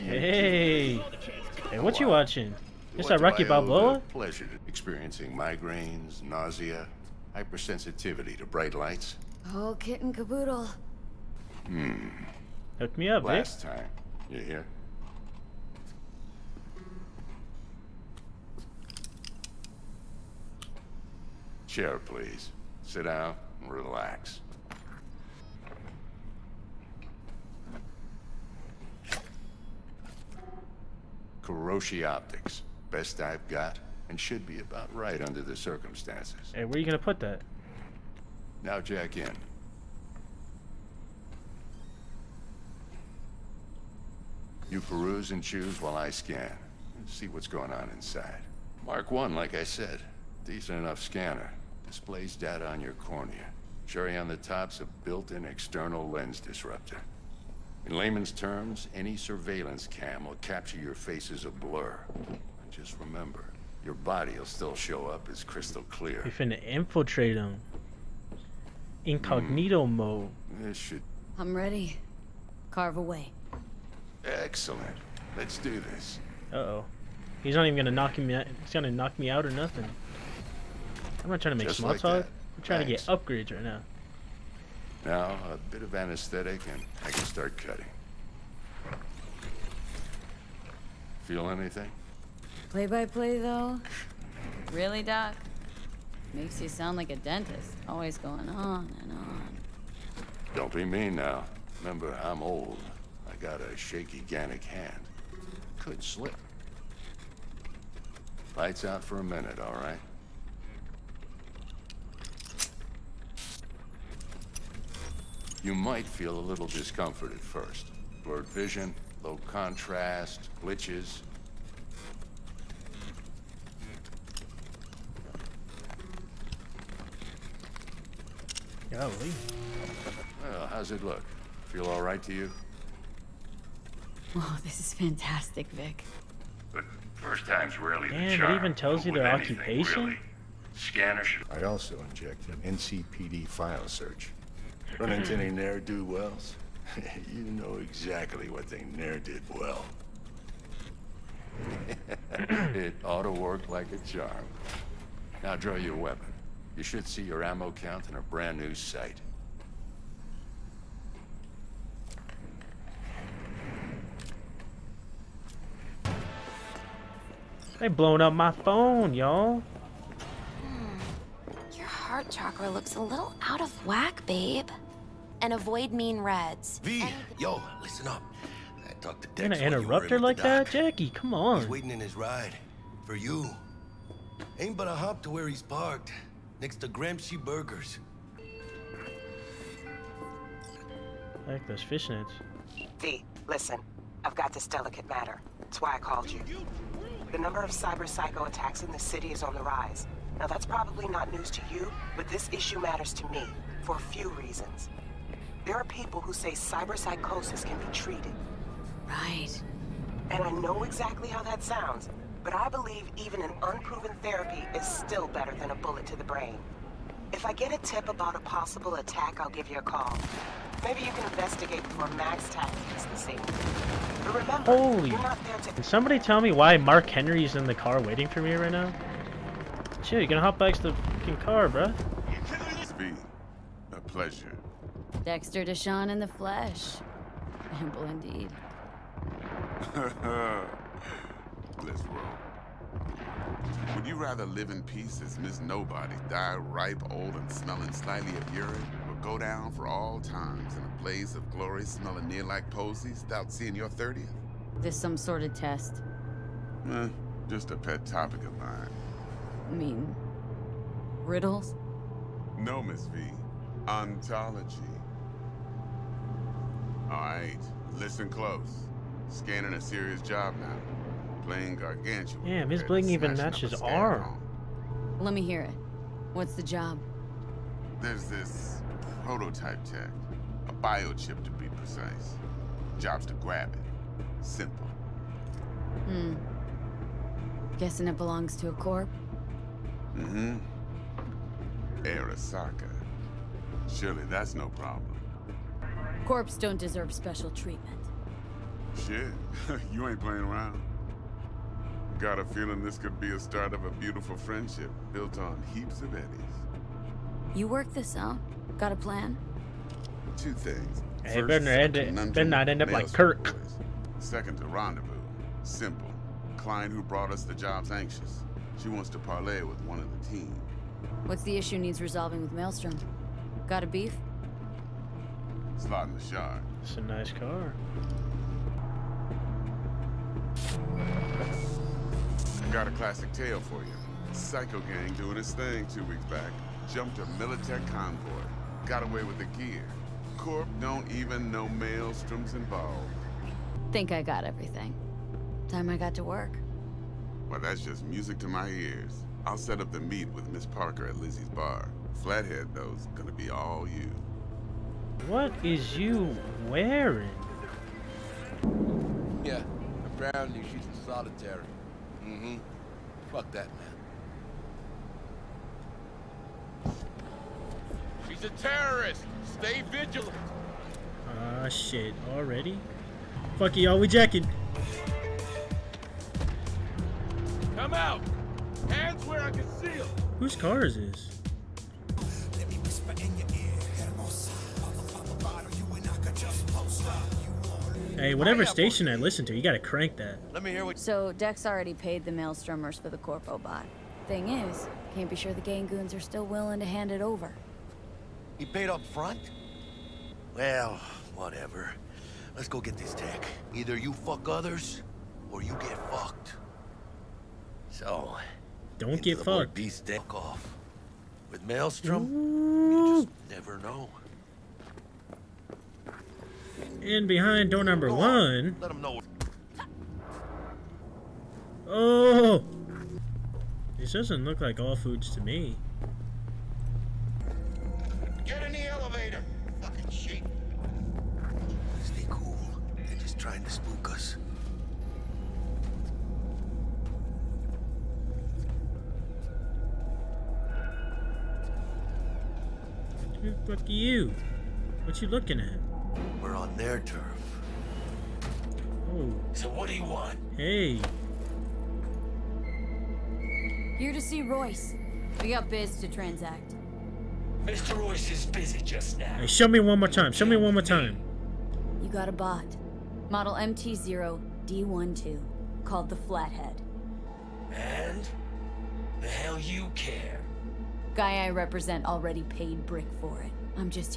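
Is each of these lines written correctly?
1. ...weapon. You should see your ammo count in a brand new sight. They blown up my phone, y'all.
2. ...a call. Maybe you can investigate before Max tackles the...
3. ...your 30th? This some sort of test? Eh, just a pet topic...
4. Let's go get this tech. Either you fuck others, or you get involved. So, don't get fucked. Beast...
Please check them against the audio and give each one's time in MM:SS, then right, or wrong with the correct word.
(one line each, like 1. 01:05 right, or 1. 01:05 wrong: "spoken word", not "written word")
1. 02:35 right
2. 03:39 right
3. 04:13 right
4. 06:42 wrong: "fucked", not "involved".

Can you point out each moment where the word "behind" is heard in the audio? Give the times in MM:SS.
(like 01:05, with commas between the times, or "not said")
06:57.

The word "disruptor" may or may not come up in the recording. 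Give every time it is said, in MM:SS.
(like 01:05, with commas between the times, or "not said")
00:56.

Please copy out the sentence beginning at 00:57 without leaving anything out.
In layman's terms, any surveillance cam will capture your face as a blur.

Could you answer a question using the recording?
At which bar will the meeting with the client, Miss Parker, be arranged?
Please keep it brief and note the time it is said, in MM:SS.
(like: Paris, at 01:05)
Lizzie's bar, at 05:51.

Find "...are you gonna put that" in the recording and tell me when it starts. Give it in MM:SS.
00:36.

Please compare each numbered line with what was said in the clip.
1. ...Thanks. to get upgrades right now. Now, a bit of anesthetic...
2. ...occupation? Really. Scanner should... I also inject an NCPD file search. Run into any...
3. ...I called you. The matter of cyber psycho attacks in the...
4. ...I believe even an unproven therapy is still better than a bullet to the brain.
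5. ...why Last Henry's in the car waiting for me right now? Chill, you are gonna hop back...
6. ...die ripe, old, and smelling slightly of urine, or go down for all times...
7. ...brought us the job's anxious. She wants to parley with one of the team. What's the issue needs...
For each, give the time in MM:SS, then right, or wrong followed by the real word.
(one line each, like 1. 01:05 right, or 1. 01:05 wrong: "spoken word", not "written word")
1. 01:22 right
2. 02:19 right
3. 03:15 wrong: "number", not "matter"
4. 03:32 right
5. 03:46 wrong: "Mark", not "Last"
6. 04:06 right
7. 05:17 right.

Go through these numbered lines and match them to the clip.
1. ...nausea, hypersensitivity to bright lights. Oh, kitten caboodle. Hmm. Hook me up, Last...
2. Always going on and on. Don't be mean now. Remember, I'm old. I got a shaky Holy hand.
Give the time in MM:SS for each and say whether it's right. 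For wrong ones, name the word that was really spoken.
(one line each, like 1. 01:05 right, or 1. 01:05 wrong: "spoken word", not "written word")
1. 00:06 right
2. 01:37 wrong: "Gannic", not "Holy".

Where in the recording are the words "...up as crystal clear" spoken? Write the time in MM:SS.
01:05.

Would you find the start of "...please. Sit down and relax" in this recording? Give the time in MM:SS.
00:22.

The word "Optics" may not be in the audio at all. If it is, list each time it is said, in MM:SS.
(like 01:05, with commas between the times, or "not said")
00:32.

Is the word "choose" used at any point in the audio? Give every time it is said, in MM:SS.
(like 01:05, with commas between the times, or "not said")
00:45.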